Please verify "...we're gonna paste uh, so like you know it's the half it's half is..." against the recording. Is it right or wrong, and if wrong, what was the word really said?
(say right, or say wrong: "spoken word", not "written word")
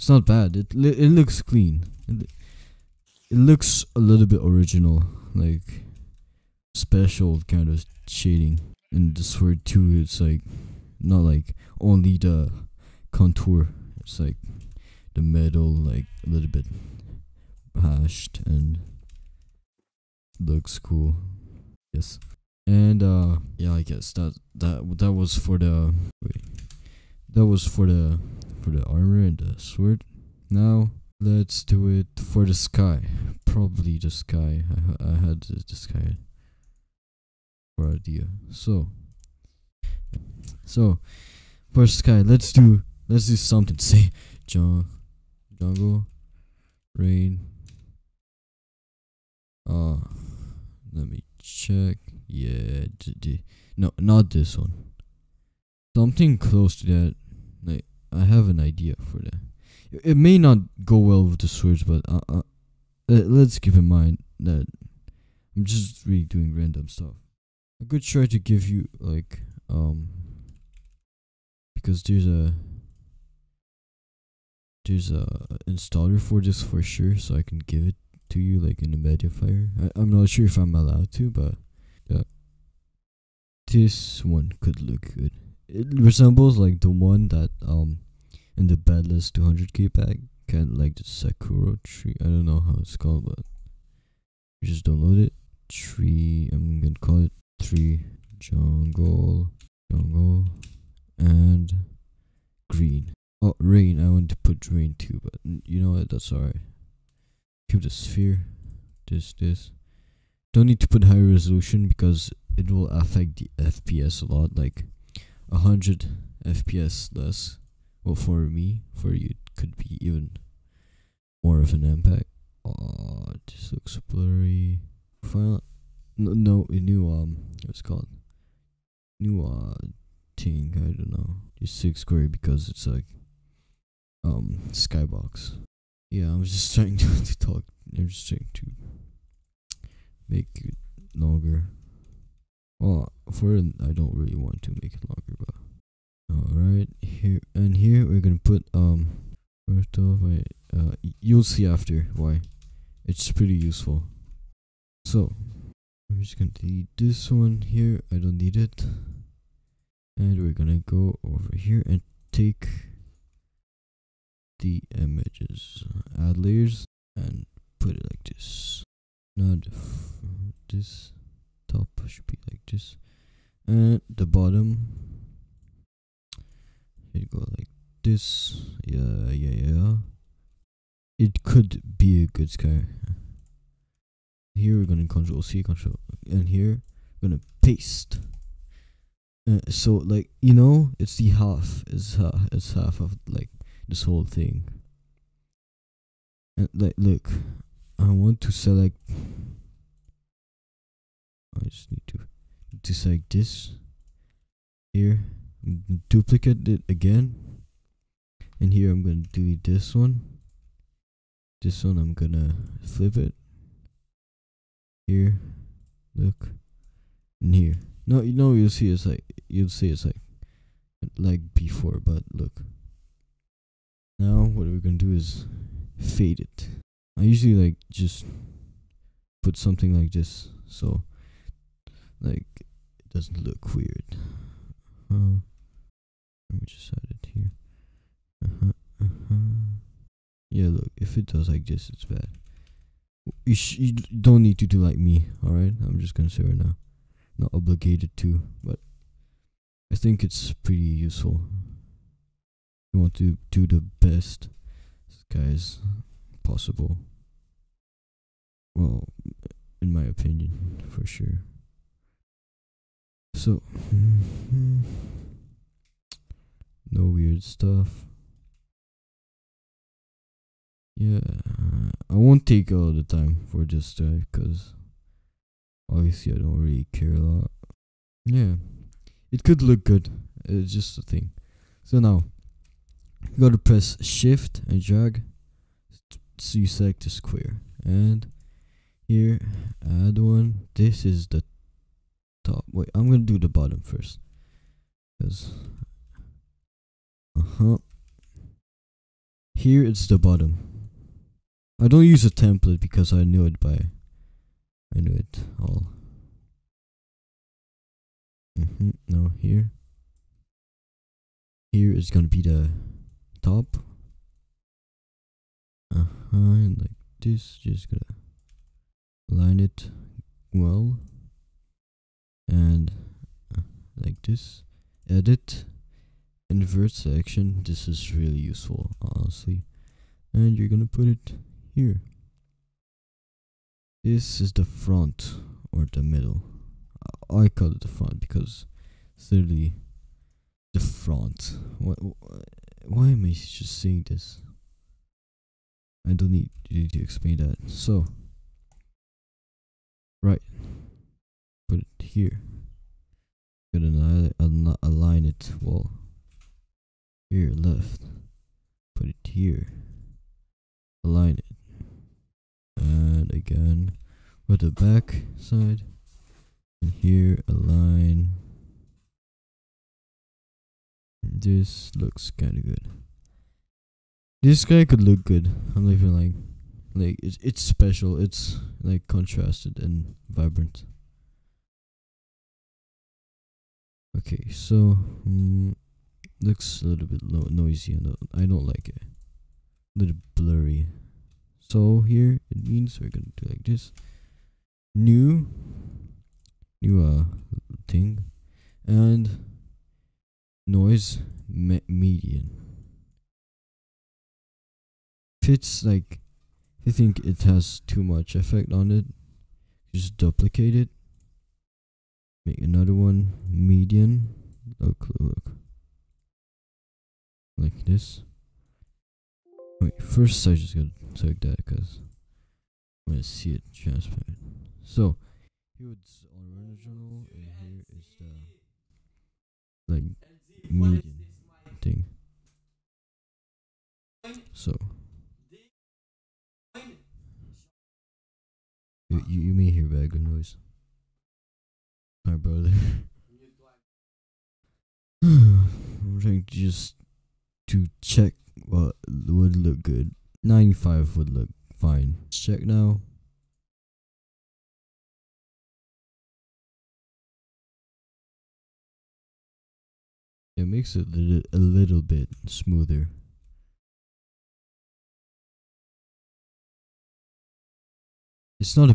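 right.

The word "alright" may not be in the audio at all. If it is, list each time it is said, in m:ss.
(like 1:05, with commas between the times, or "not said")
1:46, 2:26, 4:05.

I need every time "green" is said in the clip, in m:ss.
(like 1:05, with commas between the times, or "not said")
1:42.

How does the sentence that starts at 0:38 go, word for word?
So so for sky, let's do let's do something.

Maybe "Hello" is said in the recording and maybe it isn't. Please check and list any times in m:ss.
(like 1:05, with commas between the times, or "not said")
not said.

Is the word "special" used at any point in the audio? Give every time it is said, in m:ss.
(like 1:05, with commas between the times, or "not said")
0:06, 6:17.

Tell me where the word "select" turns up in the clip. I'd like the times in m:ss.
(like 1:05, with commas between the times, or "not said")
3:18, 3:22.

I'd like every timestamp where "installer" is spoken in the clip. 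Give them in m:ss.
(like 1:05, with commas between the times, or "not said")
1:15.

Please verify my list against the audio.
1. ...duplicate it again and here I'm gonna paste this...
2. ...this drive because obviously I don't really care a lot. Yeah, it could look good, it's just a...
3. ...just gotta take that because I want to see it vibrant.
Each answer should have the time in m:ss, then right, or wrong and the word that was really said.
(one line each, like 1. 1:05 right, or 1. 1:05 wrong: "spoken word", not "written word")
1. 3:26 wrong: "delete", not "paste"
2. 4:33 right
3. 7:00 wrong: "transparent", not "vibrant".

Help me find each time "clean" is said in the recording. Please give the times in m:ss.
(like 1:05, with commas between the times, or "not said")
0:01.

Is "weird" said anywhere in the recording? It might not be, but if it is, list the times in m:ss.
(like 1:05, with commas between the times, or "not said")
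3:53, 4:27.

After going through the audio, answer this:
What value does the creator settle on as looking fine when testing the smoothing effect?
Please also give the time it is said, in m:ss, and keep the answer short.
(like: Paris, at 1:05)
95, at 7:30.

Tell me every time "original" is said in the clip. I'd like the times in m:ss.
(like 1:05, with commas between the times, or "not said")
0:04, 7:06.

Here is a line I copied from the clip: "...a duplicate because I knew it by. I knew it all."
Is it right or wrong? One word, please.
wrong.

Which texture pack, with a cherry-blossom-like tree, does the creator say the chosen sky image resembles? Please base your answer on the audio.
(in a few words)
Bedless 200k pack.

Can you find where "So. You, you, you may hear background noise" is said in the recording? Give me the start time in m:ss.
7:14.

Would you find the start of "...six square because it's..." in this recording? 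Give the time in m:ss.
2:11.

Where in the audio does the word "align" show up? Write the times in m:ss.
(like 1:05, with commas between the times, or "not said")
5:54, 6:01, 6:07.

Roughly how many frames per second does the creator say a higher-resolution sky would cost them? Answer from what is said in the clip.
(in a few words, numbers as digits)
100.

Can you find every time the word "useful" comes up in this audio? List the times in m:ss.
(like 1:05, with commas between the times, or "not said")
2:33, 4:10, 5:28.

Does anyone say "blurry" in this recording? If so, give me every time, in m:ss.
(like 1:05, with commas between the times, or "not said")
2:04, 6:30.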